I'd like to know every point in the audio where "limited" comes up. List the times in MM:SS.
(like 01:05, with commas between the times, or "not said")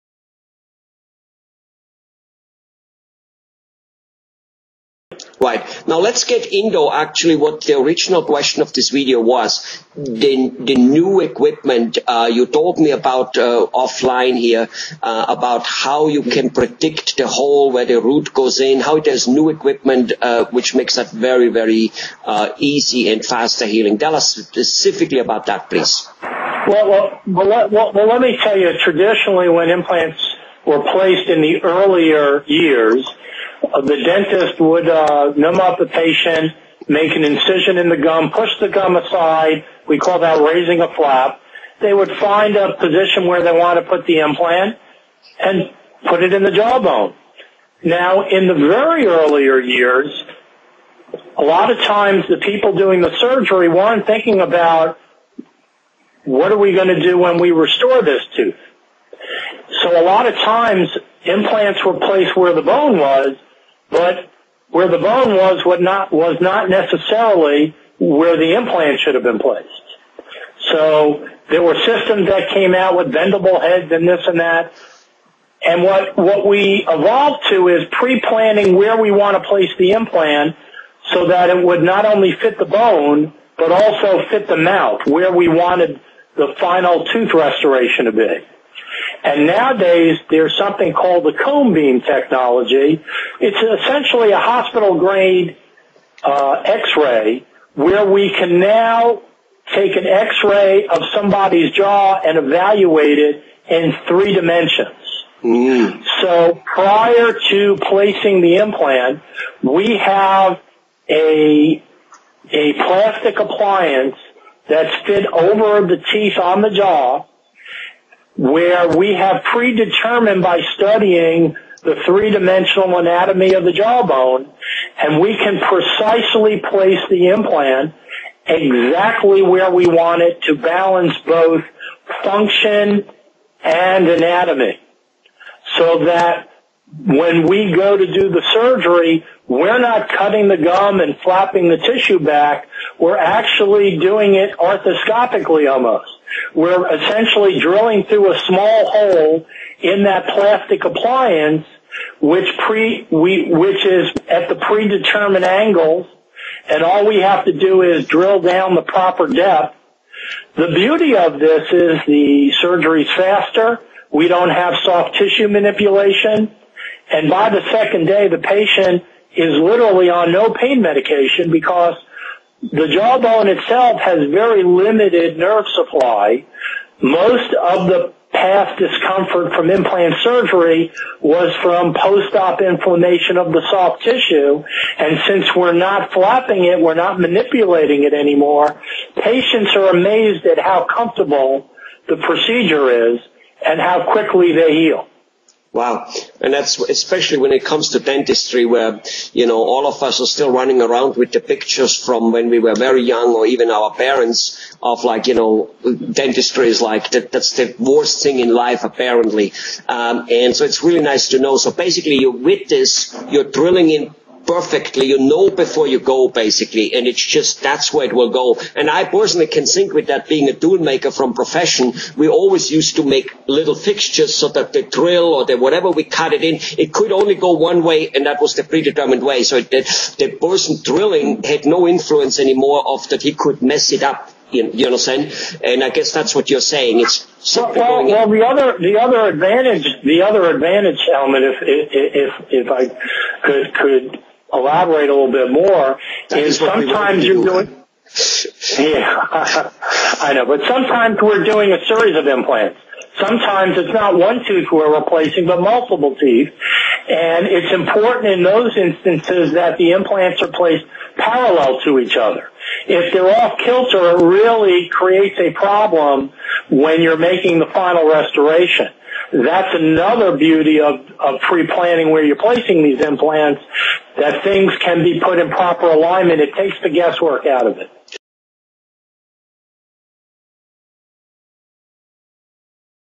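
02:54.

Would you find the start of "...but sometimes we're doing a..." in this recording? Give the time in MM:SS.
04:10.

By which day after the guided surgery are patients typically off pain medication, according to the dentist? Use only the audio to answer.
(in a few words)
Second day.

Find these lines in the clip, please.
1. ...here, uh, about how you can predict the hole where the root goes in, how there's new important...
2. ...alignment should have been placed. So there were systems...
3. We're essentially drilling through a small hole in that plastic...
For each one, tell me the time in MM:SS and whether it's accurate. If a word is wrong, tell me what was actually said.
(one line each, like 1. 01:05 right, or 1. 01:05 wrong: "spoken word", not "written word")
1. 00:14 wrong: "equipment", not "important"
2. 01:08 wrong: "implant", not "alignment"
3. 02:26 right.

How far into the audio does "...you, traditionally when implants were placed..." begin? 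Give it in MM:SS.
00:28.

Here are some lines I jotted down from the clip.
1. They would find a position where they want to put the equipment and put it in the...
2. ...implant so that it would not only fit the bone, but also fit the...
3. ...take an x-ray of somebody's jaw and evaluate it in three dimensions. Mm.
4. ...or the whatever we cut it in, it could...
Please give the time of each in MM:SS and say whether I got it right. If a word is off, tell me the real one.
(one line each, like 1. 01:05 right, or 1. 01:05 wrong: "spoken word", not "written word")
1. 00:41 wrong: "implant", not "equipment"
2. 01:19 right
3. 01:39 right
4. 03:45 right.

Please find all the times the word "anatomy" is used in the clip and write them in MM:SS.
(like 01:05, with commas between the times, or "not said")
02:02, 02:14.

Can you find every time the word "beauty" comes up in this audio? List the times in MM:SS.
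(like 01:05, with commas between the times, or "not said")
02:40, 04:30.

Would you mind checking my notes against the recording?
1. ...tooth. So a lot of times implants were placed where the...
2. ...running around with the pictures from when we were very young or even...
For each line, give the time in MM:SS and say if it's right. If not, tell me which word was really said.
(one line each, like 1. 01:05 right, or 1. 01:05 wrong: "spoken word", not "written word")
1. 00:58 right
2. 03:20 right.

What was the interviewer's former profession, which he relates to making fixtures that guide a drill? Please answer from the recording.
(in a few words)
Tool maker.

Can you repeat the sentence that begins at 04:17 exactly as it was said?
And it's important in those instances that the implants are placed parallel to each other.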